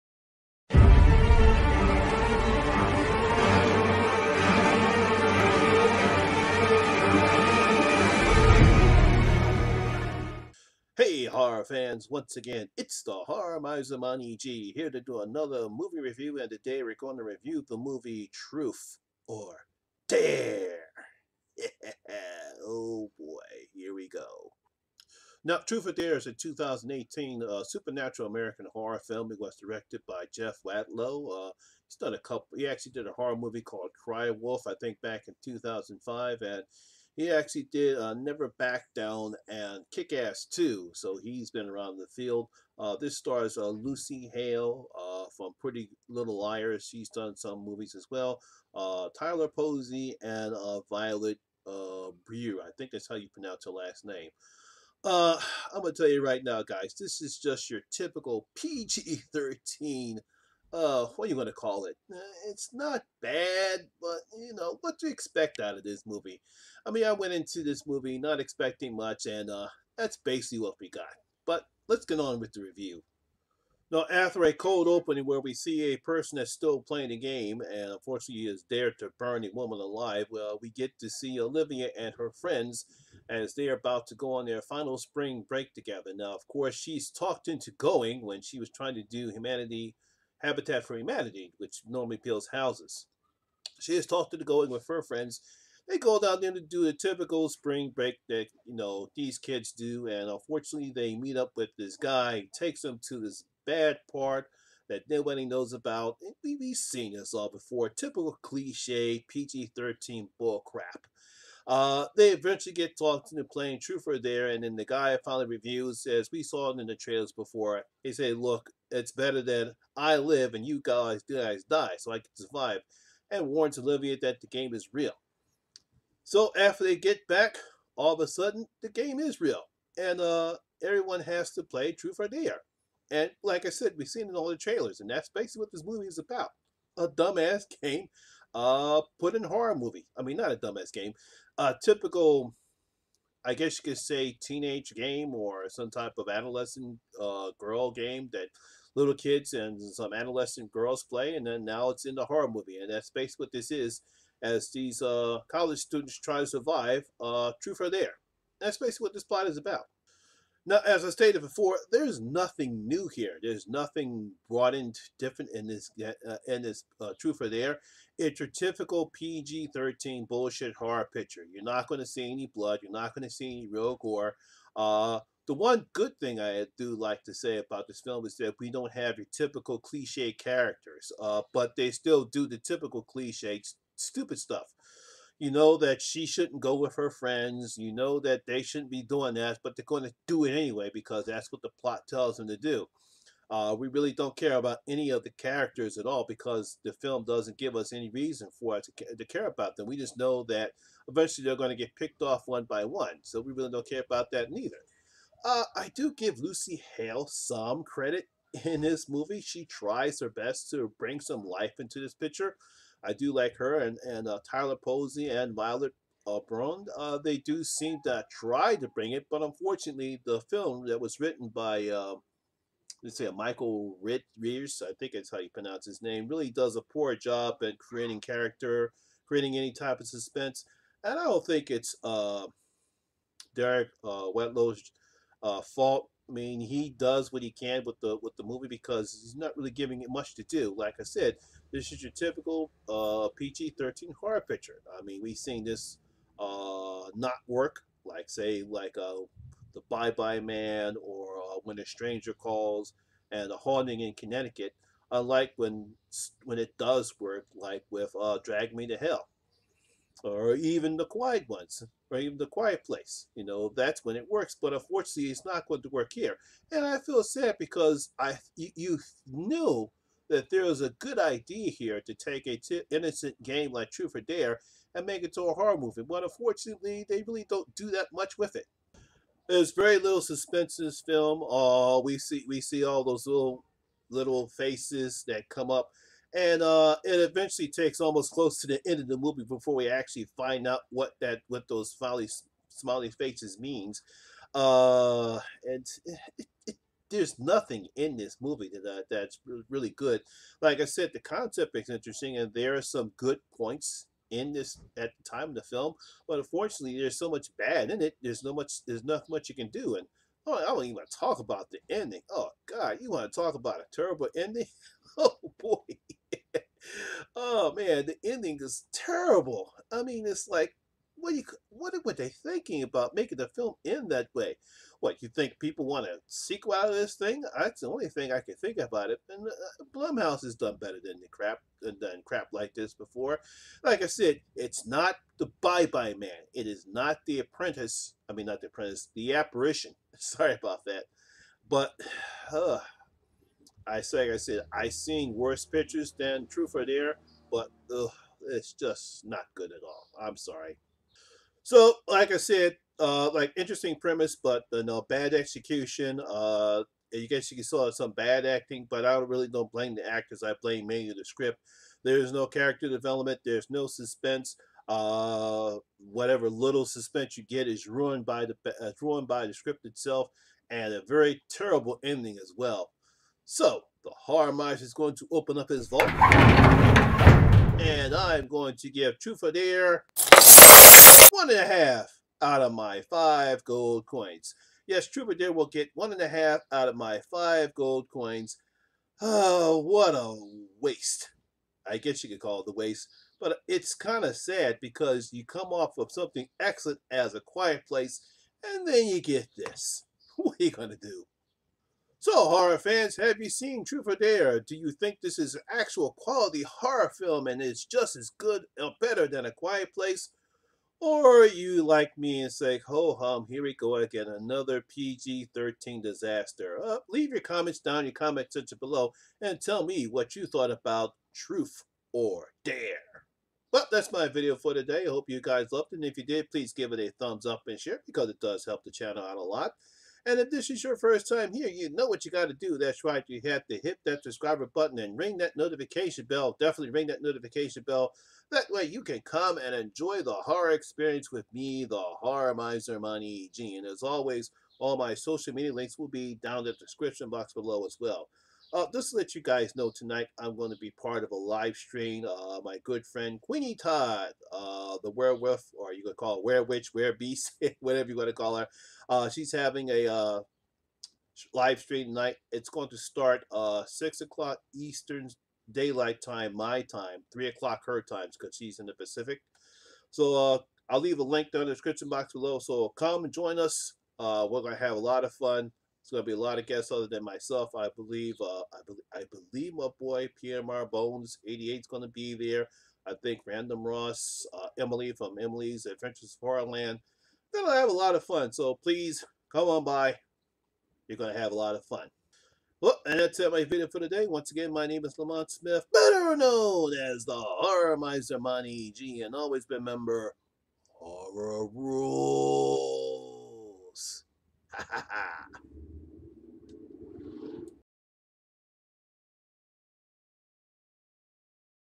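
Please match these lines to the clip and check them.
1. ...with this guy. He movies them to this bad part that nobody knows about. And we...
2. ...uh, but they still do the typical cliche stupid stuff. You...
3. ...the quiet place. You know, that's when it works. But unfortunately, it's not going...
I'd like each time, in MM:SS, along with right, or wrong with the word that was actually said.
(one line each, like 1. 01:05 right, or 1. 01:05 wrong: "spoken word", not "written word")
1. 01:41 wrong: "takes", not "movies"
2. 03:01 right
3. 04:22 right.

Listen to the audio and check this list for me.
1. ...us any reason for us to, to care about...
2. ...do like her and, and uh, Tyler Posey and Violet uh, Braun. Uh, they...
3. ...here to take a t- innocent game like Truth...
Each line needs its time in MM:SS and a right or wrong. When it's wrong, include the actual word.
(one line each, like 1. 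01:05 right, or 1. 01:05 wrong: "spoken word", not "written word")
1. 03:17 right
2. 03:33 right
3. 04:31 right.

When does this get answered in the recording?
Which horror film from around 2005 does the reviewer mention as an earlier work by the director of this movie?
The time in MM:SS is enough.
00:34.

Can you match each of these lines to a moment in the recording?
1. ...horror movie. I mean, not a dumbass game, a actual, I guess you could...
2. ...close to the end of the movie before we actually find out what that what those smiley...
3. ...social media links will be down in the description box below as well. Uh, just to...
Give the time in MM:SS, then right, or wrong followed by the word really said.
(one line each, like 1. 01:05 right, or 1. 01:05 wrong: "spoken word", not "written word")
1. 02:19 wrong: "typical", not "actual"
2. 04:48 right
3. 07:25 right.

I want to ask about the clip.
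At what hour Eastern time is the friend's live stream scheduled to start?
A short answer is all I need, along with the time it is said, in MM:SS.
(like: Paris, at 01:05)
6 o'clock, at 07:43.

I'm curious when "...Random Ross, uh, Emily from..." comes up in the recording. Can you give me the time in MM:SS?
08:03.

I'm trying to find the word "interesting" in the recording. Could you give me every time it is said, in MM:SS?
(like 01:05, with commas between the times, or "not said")
05:01, 05:53.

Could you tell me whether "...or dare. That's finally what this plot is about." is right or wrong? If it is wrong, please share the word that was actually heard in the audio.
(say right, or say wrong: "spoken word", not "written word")
wrong: "basically", not "finally".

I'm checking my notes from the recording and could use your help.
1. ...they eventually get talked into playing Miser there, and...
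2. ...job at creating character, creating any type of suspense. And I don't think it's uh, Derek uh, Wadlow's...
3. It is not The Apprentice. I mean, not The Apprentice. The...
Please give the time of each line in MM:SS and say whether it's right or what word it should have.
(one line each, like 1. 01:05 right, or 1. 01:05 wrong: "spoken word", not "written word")
1. 01:52 wrong: "Trooper", not "Miser"
2. 03:47 right
3. 05:36 right.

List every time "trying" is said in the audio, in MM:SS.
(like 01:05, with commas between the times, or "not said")
01:28.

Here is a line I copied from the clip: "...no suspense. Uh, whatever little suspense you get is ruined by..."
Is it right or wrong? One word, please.
right.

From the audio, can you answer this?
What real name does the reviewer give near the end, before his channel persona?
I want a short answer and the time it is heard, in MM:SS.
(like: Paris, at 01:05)
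Lamont Smith, at 08:15.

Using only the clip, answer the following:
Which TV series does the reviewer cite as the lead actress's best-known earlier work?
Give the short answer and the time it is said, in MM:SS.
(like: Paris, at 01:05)
Pretty Little Liars, at 00:45.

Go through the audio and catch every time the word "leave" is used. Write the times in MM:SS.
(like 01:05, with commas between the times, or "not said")
06:57, 07:51.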